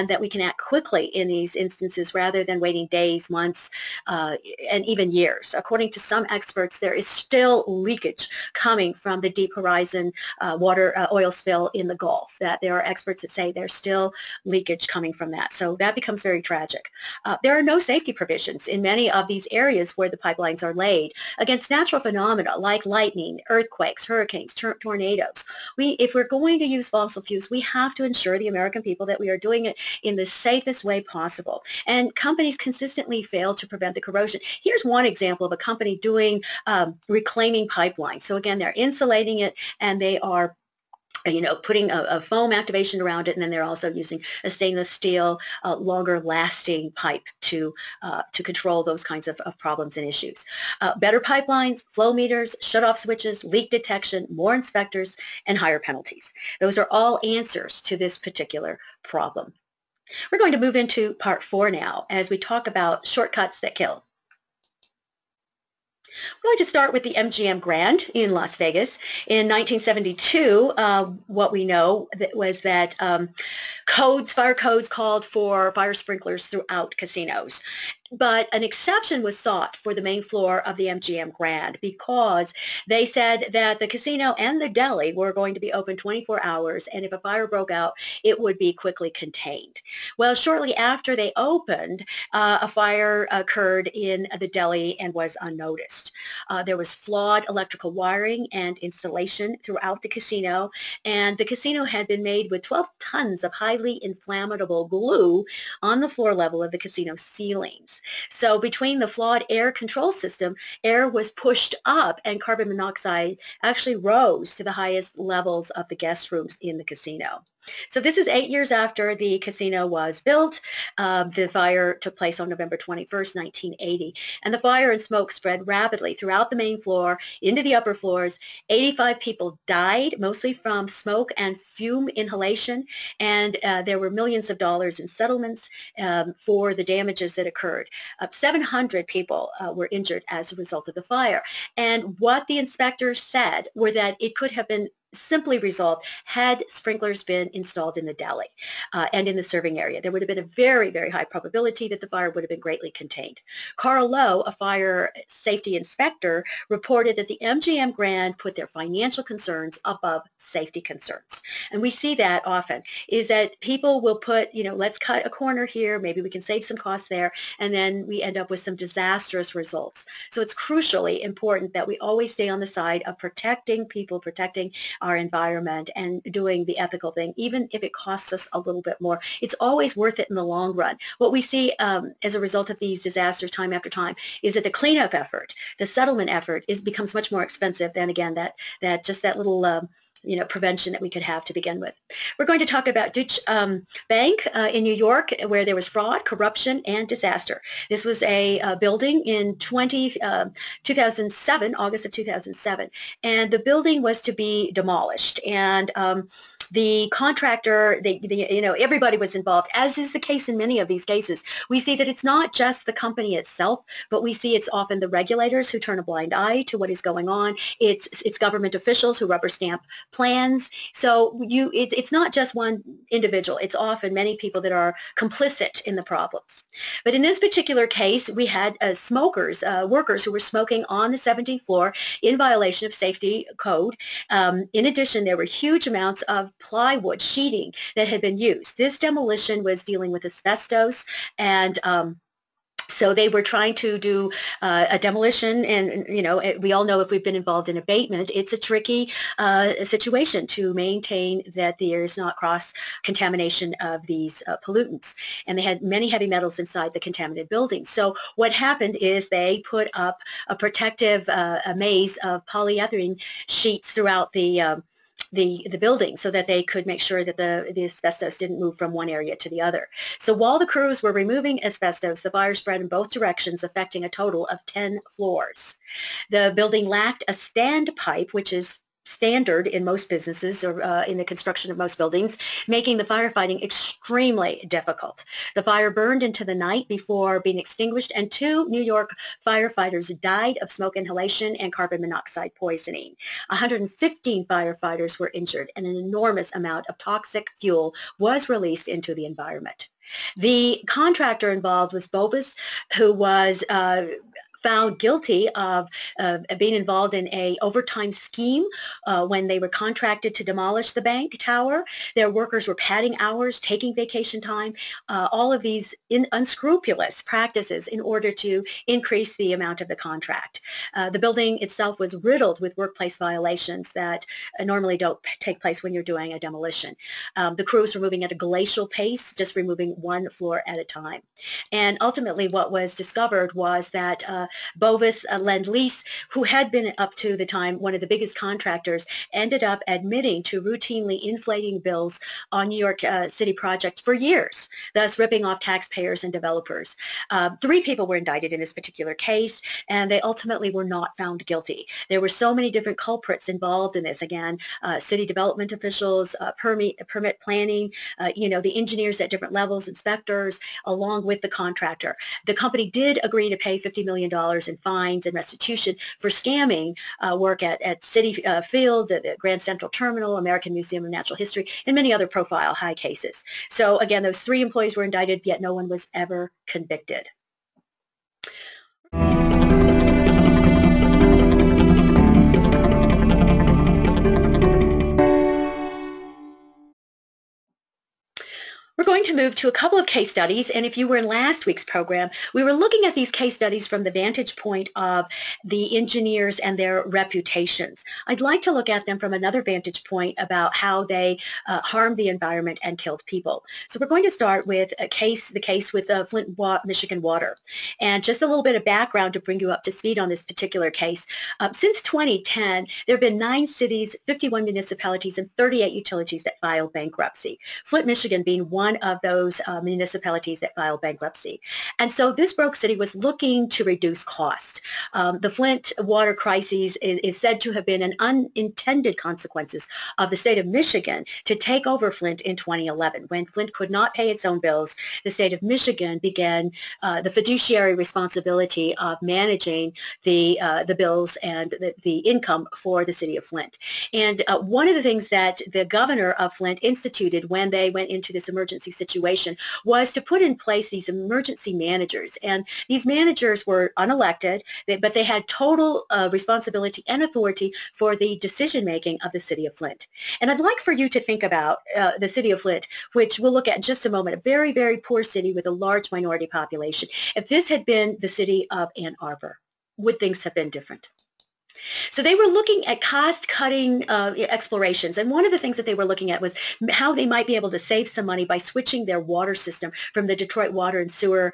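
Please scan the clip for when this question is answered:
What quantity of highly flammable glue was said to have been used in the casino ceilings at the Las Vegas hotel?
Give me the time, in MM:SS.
01:42.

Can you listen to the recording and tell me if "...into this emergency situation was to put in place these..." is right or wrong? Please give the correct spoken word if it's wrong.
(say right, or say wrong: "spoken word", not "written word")
right.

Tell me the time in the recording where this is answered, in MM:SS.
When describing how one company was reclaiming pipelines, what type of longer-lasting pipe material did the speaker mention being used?
00:44.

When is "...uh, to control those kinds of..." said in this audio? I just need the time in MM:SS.
00:48.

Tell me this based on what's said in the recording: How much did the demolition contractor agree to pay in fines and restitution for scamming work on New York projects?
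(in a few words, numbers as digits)
$50 million.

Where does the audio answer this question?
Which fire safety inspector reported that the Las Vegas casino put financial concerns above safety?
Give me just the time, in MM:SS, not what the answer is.
02:33.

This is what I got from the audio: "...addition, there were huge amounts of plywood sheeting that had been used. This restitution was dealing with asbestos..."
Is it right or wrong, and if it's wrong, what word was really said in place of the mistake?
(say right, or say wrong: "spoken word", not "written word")
wrong: "demolition", not "restitution".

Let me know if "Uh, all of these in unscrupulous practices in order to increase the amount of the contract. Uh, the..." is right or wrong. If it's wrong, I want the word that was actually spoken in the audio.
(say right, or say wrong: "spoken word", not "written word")
right.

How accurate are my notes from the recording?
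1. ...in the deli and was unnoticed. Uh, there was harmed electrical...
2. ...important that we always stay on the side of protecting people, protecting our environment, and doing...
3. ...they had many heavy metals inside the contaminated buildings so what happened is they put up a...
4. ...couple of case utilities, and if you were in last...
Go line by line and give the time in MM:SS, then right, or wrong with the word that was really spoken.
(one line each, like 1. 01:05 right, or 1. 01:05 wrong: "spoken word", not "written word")
1. 01:33 wrong: "flawed", not "harmed"
2. 02:51 right
3. 04:15 right
4. 06:29 wrong: "studies", not "utilities".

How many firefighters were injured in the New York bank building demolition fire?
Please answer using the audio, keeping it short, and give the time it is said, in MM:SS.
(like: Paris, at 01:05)
115, at 04:53.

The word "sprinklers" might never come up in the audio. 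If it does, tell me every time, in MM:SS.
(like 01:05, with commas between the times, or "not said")
01:15, 02:26.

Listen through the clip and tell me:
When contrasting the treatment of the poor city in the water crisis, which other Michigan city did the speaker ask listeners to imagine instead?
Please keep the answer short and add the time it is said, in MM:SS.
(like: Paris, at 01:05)
Ann Arbor, at 07:48.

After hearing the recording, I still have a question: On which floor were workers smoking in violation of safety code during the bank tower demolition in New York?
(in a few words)
17th floor.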